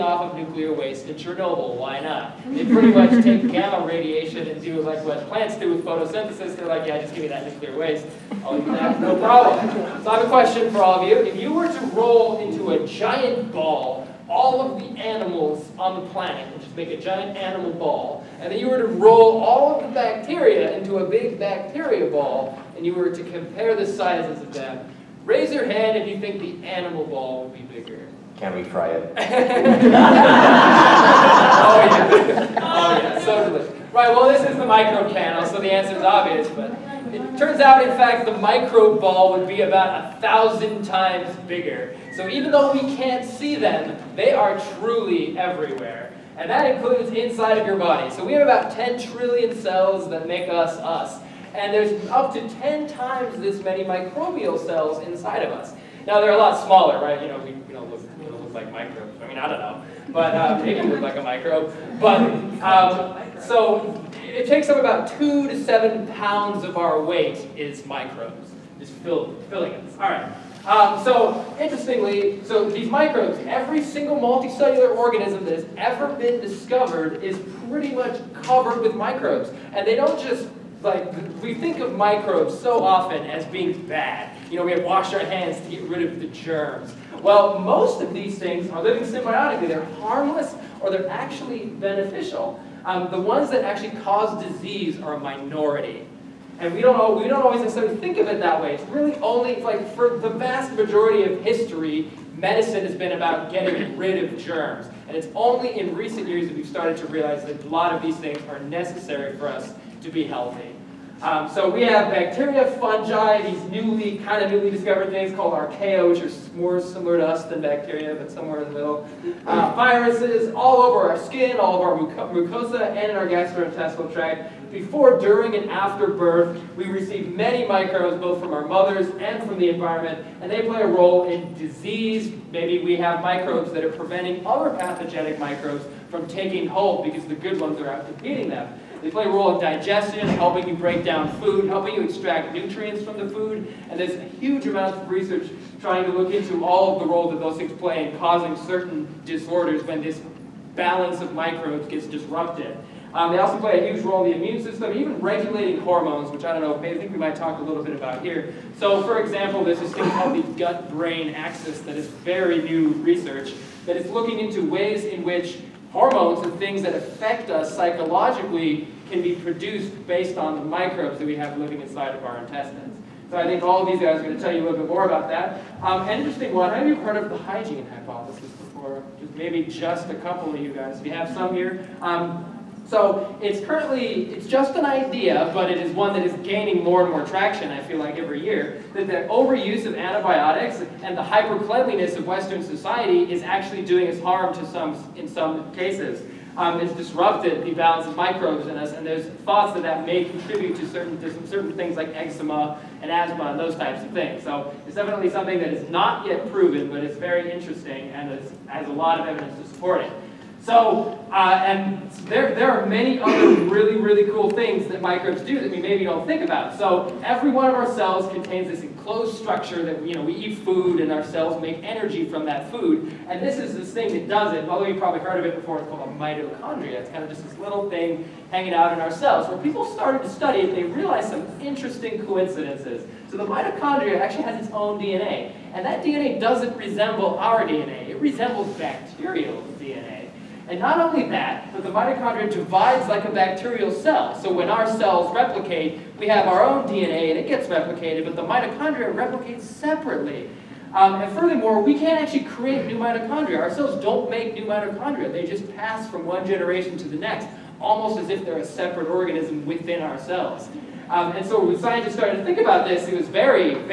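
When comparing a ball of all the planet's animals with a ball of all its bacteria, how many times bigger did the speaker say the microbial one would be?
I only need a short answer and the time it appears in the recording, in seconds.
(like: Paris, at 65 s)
1000, at 40 s.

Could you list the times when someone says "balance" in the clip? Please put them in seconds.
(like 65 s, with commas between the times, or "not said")
150 s, 197 s.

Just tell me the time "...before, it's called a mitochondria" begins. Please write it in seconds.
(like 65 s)
225 s.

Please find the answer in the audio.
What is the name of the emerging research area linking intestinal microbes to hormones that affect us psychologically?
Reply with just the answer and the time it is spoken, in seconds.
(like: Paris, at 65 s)
gut-brain axis, at 160 s.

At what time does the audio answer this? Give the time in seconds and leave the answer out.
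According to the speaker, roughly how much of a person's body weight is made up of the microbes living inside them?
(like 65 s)
65 s.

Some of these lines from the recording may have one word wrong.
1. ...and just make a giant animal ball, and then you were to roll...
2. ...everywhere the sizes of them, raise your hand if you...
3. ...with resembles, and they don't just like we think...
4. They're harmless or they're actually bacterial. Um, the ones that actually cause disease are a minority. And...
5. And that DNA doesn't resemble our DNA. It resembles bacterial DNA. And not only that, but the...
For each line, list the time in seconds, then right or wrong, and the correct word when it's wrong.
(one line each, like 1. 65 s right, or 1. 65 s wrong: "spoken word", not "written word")
1. 16 s right
2. 23 s wrong: "compare", not "everywhere"
3. 78 s wrong: "microbes", not "resembles"
4. 89 s wrong: "beneficial", not "bacterial"
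5. 235 s right.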